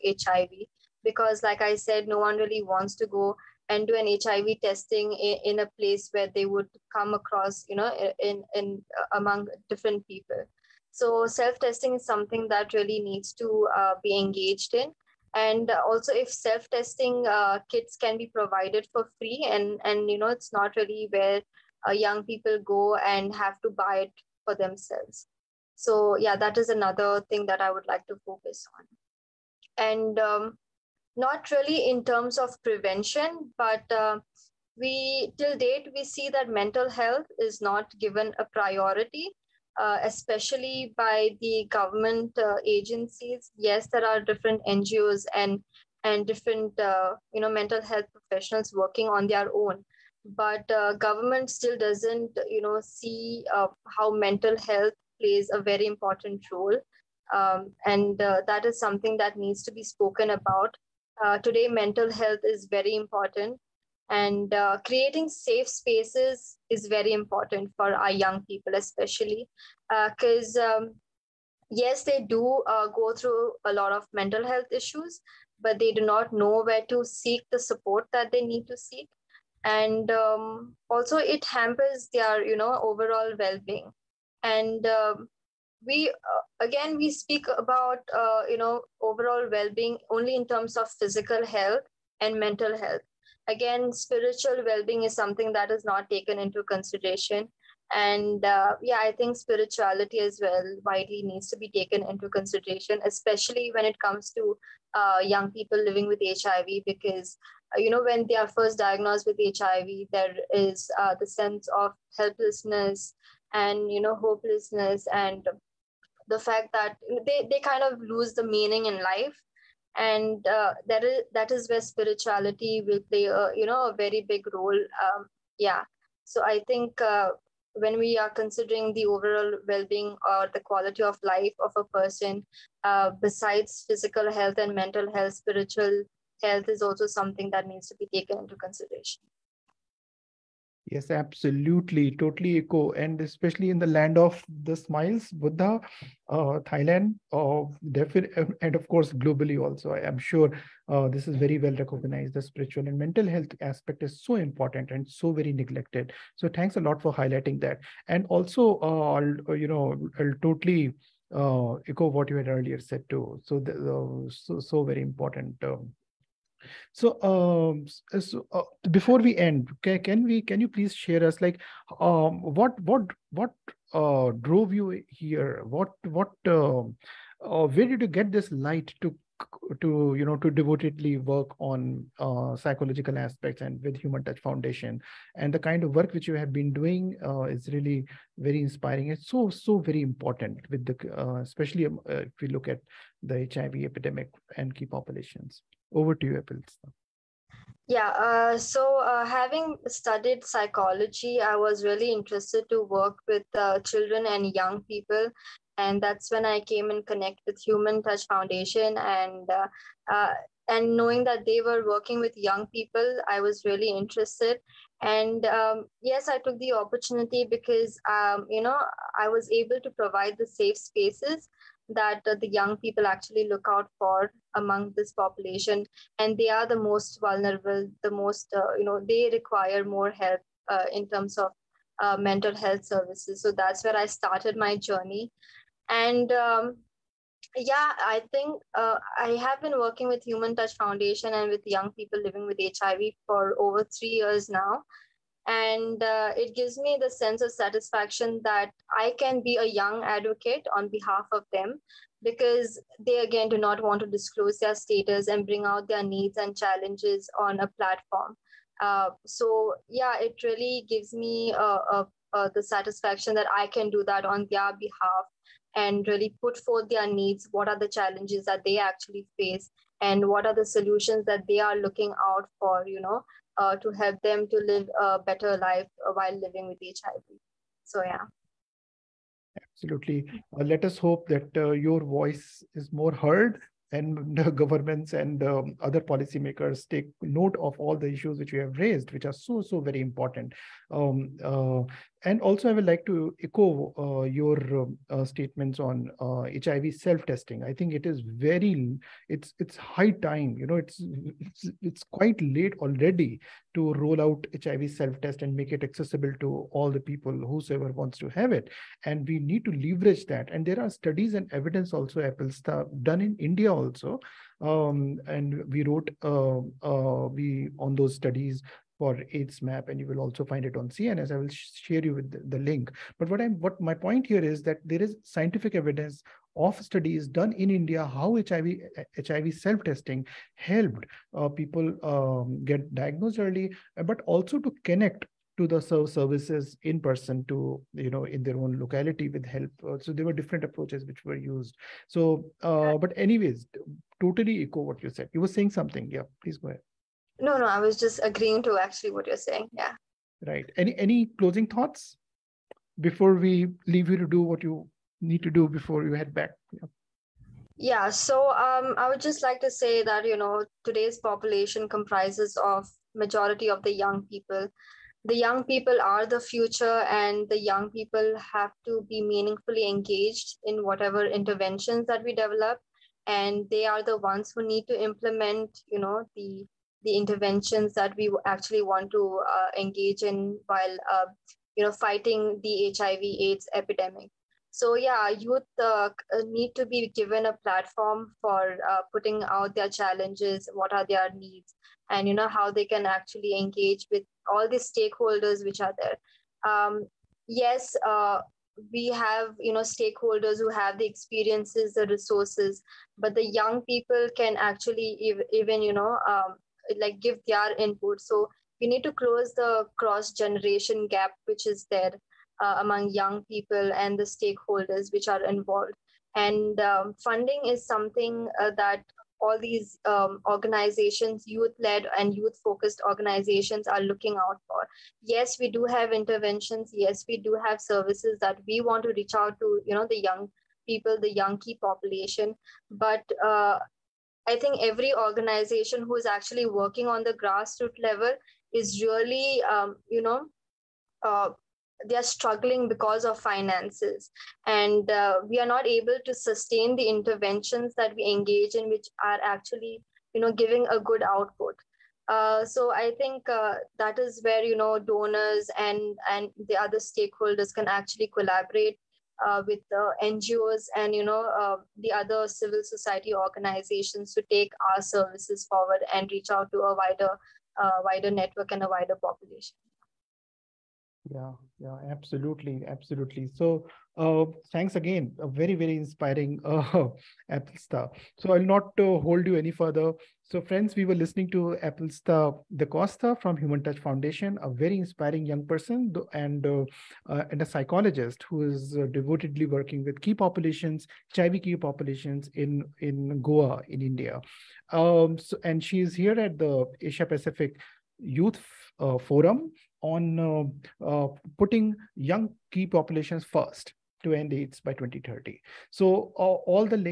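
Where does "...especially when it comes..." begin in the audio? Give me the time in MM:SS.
01:43.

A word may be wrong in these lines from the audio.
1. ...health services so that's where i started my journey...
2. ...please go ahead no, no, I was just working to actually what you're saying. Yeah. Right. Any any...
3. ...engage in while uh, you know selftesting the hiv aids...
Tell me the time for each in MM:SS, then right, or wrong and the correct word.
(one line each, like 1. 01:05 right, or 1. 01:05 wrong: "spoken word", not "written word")
1. 03:52 right
2. 05:46 wrong: "agreeing", not "working"
3. 06:19 wrong: "fighting", not "selftesting".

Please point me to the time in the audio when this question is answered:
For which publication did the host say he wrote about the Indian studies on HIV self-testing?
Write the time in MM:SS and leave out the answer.
05:19.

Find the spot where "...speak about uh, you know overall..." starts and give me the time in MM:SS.
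01:27.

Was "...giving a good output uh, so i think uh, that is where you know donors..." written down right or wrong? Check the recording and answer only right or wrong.
right.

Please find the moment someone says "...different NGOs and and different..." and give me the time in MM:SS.
00:44.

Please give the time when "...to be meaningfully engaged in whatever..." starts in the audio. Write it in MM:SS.
06:08.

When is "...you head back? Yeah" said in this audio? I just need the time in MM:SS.
05:56.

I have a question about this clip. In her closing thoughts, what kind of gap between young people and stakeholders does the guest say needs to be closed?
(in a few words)
Cross generation gap.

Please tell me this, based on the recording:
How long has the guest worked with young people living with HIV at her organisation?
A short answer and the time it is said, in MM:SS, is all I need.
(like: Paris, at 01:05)
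Over three years, at 04:03.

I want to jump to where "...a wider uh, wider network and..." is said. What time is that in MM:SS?
07:46.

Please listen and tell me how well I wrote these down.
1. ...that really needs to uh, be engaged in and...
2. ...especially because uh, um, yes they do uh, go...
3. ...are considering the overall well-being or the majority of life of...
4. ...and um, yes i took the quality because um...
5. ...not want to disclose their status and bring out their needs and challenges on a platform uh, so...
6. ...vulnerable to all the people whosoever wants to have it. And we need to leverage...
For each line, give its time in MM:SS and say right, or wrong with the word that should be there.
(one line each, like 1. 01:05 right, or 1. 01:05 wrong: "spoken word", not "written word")
1. 00:12 right
2. 01:08 right
3. 02:08 wrong: "quality", not "majority"
4. 03:35 wrong: "opportunity", not "quality"
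5. 04:13 right
6. 05:05 wrong: "accessible", not "vulnerable".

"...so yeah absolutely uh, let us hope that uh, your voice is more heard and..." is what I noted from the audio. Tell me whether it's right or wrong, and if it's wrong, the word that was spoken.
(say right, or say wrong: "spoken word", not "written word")
right.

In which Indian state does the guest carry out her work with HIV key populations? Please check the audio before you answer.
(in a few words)
Goa.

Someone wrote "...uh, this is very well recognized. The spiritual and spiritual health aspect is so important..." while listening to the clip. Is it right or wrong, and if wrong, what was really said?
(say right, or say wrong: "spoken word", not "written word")
wrong: "mental", not "spiritual".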